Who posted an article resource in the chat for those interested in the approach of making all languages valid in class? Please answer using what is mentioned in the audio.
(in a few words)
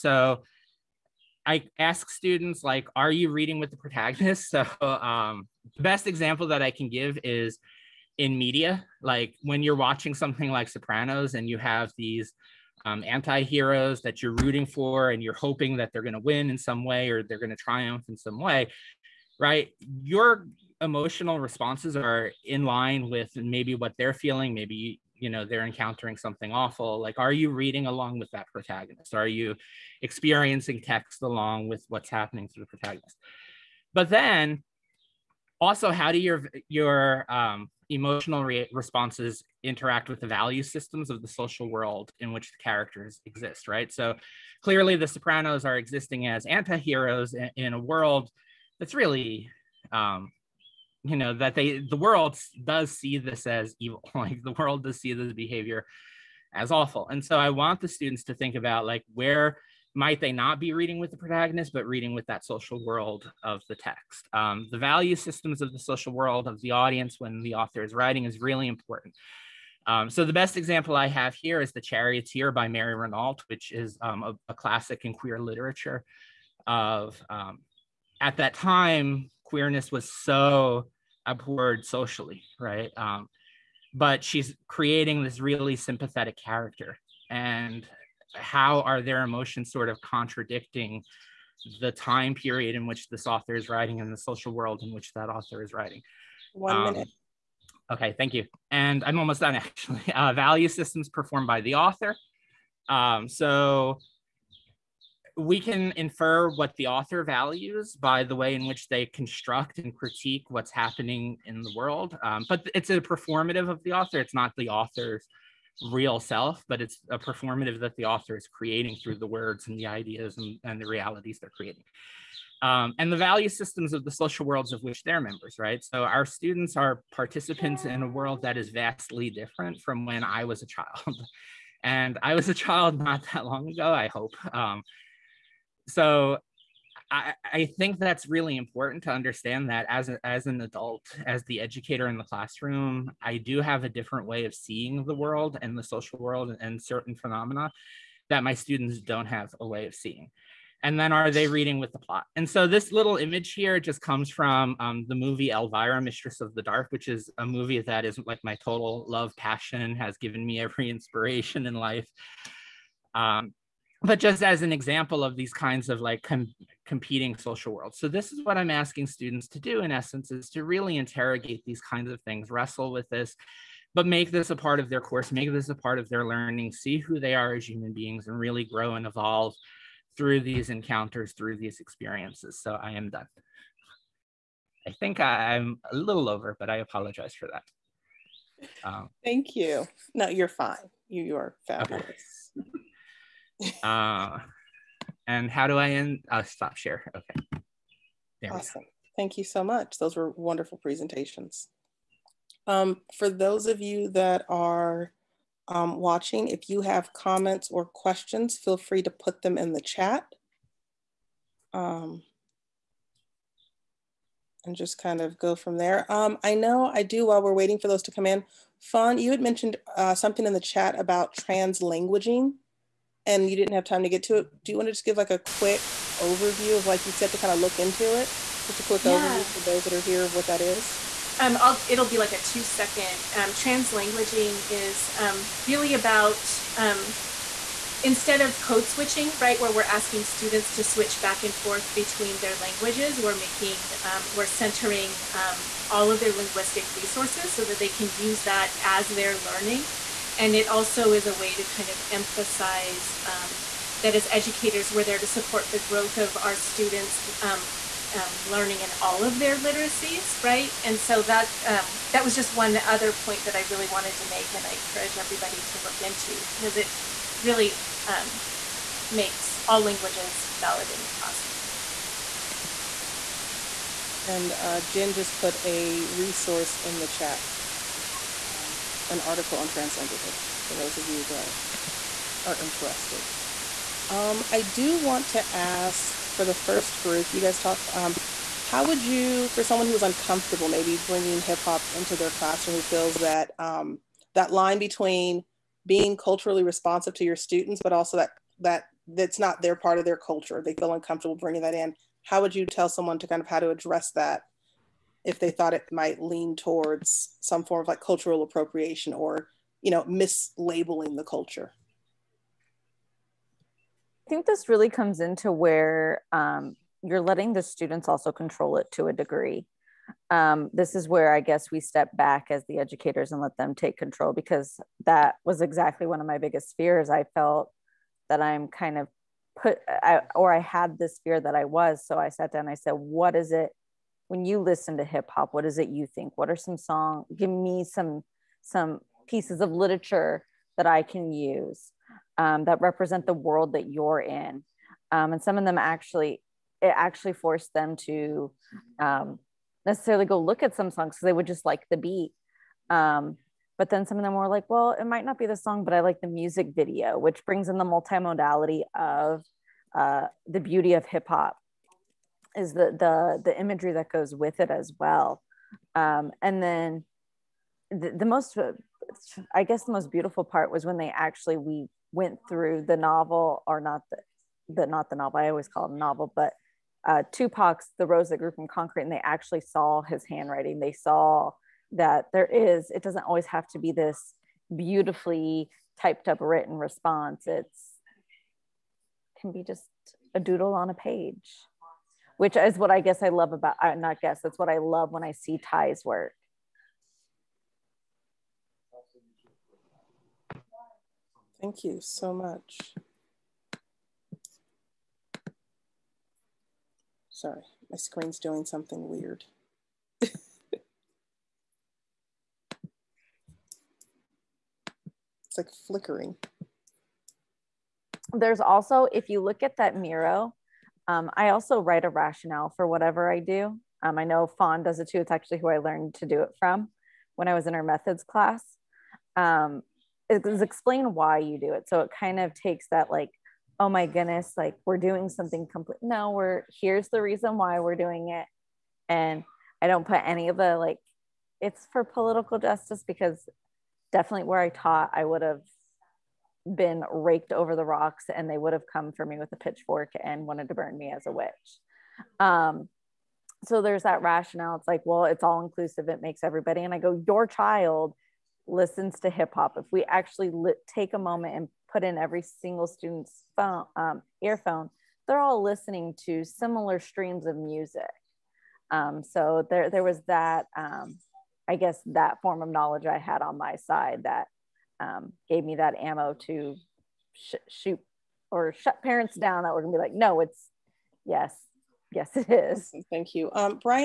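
Jen.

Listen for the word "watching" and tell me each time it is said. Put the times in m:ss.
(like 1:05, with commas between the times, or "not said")
0:09, 3:25.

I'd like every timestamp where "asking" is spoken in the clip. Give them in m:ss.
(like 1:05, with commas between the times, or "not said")
2:48, 3:59.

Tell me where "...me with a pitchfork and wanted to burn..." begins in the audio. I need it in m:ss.
7:29.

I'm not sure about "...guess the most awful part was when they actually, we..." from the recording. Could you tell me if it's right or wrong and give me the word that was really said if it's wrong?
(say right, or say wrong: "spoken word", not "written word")
wrong: "beautiful", not "awful".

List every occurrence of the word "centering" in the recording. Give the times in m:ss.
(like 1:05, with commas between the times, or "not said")
4:04.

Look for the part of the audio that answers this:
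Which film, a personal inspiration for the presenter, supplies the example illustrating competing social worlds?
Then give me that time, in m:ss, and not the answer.
2:35.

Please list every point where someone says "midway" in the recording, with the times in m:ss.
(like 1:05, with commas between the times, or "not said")
not said.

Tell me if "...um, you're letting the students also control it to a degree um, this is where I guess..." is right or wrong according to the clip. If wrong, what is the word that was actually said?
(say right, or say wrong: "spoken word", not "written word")
right.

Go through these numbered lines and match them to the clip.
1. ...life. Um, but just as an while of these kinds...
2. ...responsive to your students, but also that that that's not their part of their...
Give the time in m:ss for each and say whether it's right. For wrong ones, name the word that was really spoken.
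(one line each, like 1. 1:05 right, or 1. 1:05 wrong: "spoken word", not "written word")
1. 2:41 wrong: "example", not "while"
2. 4:56 right.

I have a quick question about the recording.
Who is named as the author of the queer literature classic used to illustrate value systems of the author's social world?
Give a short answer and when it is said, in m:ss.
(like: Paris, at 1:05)
Mary Renault, at 1:12.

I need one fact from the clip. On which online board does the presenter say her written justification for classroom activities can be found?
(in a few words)
Miro.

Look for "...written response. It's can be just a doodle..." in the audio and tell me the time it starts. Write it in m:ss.
6:26.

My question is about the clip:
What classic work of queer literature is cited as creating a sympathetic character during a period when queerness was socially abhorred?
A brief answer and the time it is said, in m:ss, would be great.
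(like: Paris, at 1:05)
The Charioteer, at 1:11.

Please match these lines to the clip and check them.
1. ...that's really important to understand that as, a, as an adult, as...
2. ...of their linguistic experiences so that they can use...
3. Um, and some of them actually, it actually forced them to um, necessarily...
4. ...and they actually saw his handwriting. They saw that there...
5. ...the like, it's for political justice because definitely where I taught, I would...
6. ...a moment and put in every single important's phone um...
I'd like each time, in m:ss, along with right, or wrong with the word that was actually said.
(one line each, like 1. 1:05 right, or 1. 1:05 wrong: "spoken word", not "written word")
1. 2:17 right
2. 4:06 wrong: "resources", not "experiences"
3. 5:45 right
4. 6:19 right
5. 7:20 right
6. 7:41 wrong: "student", not "important".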